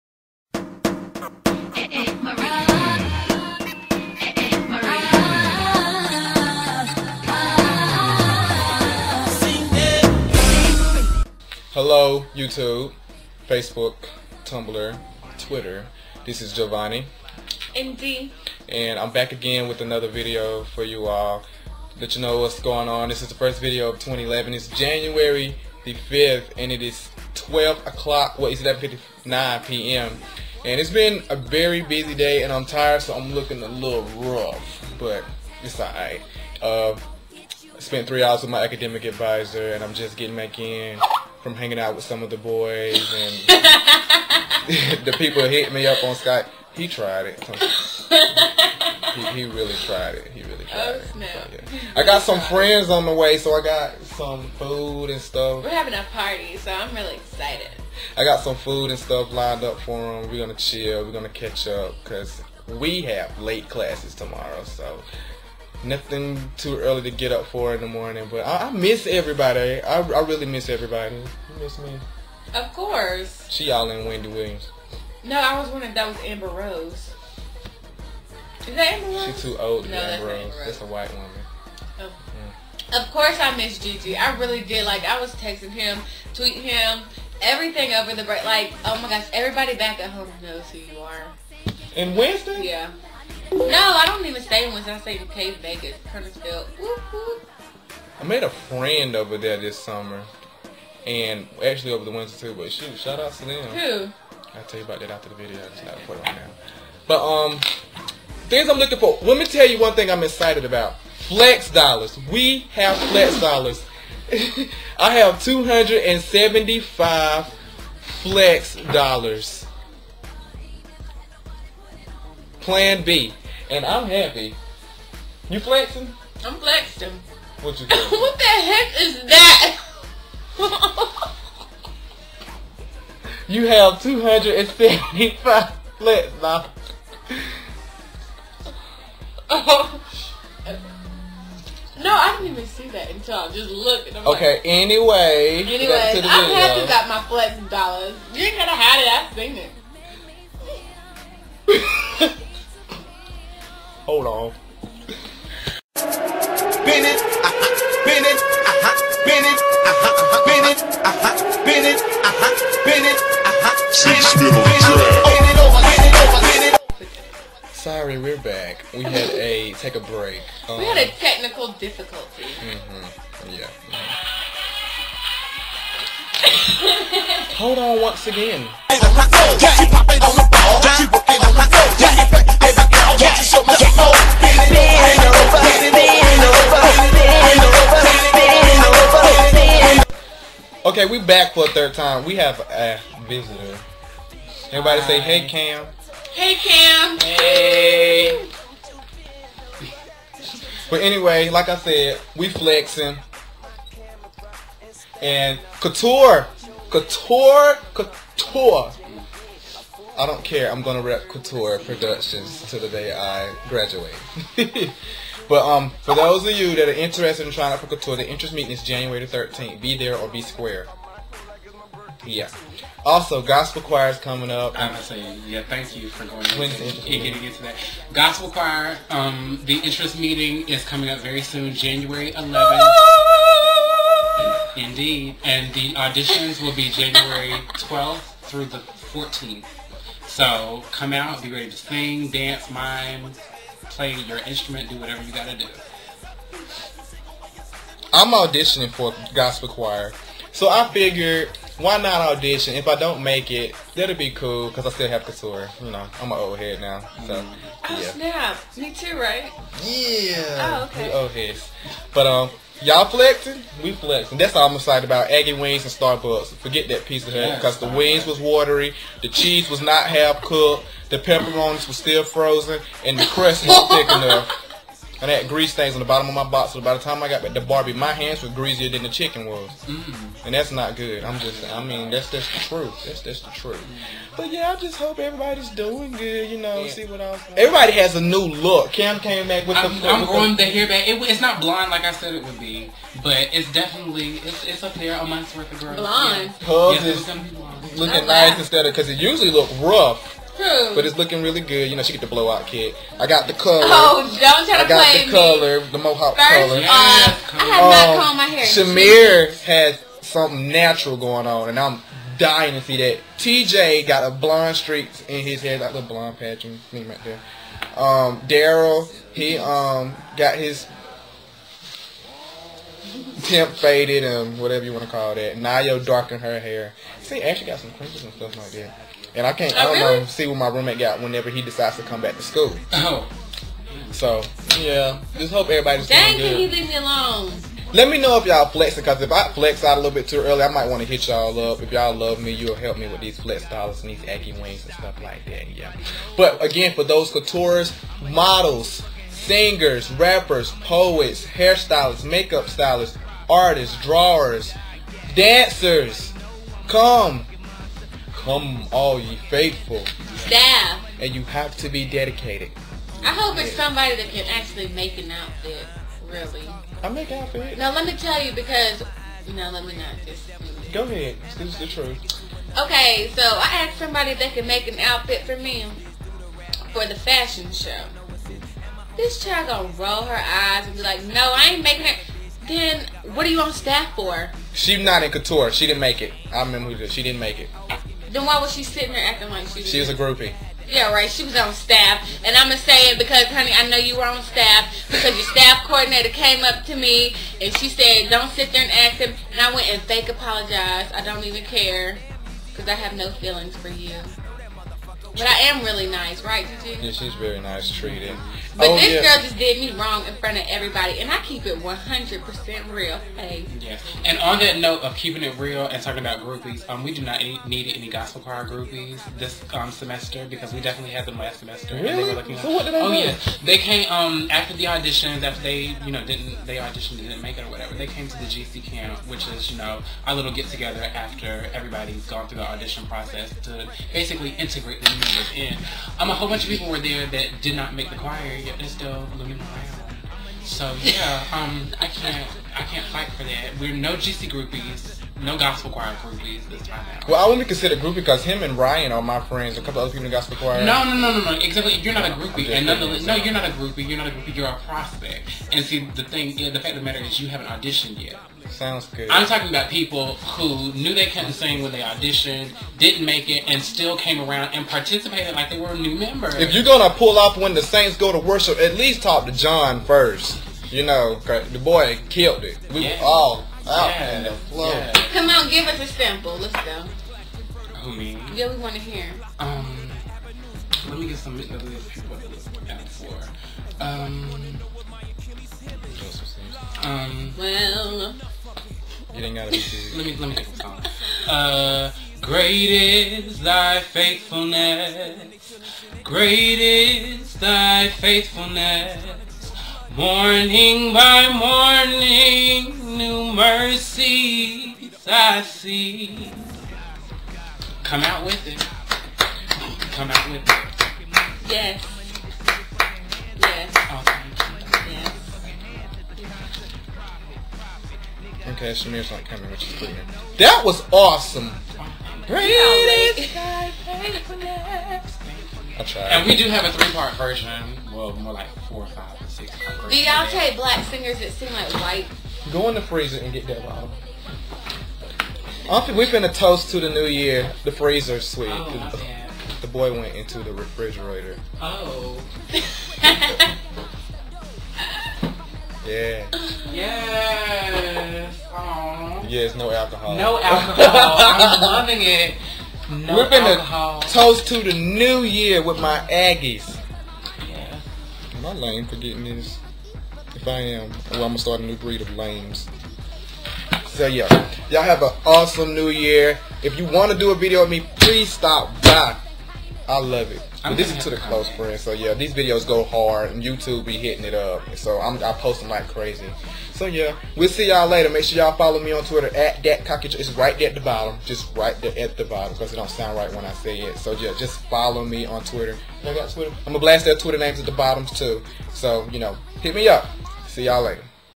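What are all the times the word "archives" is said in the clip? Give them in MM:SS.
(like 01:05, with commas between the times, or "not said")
not said.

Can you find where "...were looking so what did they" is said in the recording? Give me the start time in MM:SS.
07:02.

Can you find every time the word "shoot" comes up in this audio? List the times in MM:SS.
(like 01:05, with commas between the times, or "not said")
01:42.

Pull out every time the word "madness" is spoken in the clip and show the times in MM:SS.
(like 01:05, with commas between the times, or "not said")
not said.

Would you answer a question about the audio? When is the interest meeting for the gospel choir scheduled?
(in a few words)
January 11.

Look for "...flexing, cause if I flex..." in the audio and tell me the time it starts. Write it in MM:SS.
05:38.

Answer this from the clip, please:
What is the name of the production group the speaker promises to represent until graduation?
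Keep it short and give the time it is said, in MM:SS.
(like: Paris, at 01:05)
Couture Productions, at 03:31.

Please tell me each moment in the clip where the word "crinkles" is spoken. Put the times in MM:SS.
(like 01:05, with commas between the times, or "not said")
05:27.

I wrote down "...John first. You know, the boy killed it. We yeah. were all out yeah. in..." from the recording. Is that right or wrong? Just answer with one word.
right.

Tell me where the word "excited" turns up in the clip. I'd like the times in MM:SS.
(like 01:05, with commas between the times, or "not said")
00:57, 01:50, 04:24.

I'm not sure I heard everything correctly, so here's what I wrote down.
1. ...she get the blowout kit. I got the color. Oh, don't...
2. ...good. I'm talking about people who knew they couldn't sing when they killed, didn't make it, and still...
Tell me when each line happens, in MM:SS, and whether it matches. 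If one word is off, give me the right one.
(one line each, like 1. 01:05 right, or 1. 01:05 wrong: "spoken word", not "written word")
1. 05:02 right
2. 07:39 wrong: "auditioned", not "killed".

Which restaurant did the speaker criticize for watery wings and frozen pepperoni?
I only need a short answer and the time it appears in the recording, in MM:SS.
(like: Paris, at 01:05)
Pizza Hut, at 04:27.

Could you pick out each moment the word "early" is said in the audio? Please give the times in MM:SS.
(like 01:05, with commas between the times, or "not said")
01:06, 05:40.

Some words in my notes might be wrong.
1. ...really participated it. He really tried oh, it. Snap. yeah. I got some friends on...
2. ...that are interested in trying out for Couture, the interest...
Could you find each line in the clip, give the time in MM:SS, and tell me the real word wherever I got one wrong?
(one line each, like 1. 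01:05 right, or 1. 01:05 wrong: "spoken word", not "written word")
1. 00:49 wrong: "tried", not "participated"
2. 03:36 right.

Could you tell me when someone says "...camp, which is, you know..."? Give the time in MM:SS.
07:08.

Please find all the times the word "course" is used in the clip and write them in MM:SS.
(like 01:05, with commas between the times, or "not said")
01:12, 01:23.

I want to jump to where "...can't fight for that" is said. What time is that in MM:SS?
07:22.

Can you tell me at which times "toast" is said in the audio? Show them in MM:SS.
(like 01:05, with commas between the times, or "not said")
08:56, 09:14.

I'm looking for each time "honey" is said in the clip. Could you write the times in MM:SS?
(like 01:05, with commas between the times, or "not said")
06:33.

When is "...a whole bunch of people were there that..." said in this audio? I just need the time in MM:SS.
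07:16.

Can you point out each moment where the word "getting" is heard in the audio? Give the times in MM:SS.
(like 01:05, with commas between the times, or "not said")
00:40, 03:47, 09:19.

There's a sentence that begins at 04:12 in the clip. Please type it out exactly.
If I don't make it, that'll be cool because I still have couture.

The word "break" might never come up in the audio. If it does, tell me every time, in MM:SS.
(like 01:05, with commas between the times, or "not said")
01:28, 02:50.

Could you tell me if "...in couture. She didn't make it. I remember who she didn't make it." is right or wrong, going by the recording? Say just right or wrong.
right.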